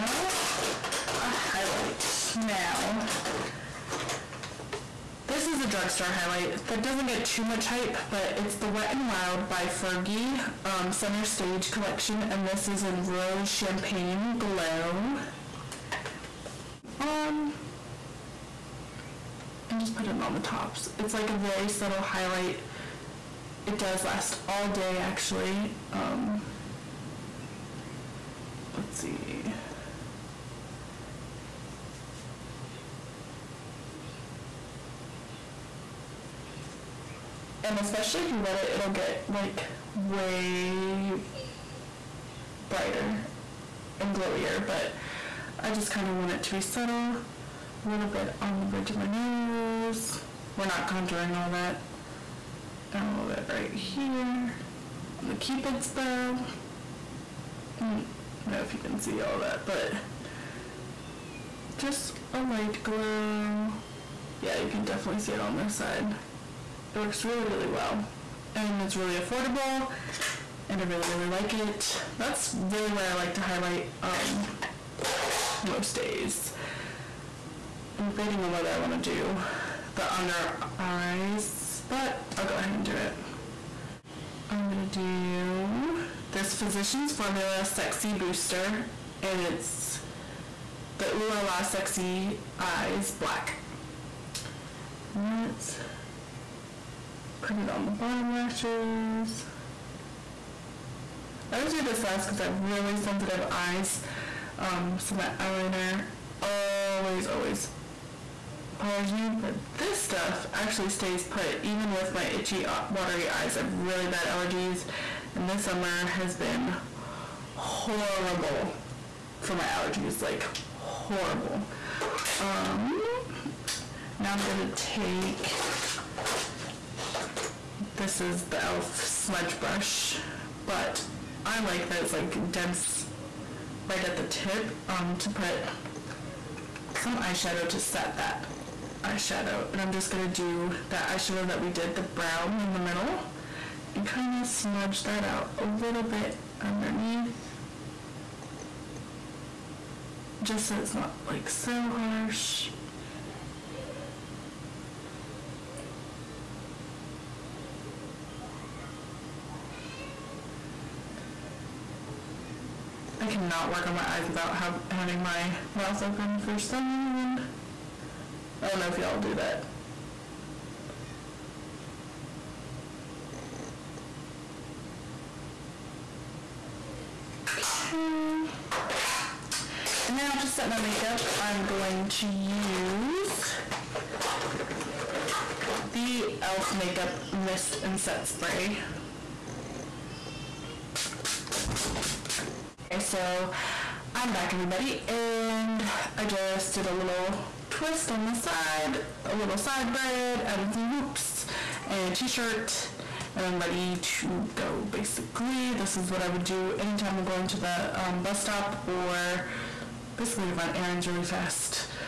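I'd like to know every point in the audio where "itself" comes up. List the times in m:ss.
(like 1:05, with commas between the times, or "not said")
not said.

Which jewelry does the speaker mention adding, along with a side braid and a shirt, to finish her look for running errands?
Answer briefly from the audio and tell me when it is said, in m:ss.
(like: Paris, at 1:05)
hoops, at 3:20.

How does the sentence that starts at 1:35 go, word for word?
Let's put it on the bottom lashes.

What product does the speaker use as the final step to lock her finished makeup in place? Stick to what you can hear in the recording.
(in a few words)
e.l.f. Makeup Mist and Set Spray.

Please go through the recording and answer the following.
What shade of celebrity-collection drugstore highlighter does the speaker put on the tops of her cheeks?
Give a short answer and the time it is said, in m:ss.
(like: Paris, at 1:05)
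Rose Champagne Glow, at 0:13.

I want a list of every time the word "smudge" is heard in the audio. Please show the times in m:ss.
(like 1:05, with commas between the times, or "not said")
2:08, 2:24.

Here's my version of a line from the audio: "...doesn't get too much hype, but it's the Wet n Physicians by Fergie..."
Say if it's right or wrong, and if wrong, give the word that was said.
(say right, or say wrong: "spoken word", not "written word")
wrong: "Wild", not "Physicians".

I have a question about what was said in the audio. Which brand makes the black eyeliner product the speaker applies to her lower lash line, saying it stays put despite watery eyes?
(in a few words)
Physicians Formula.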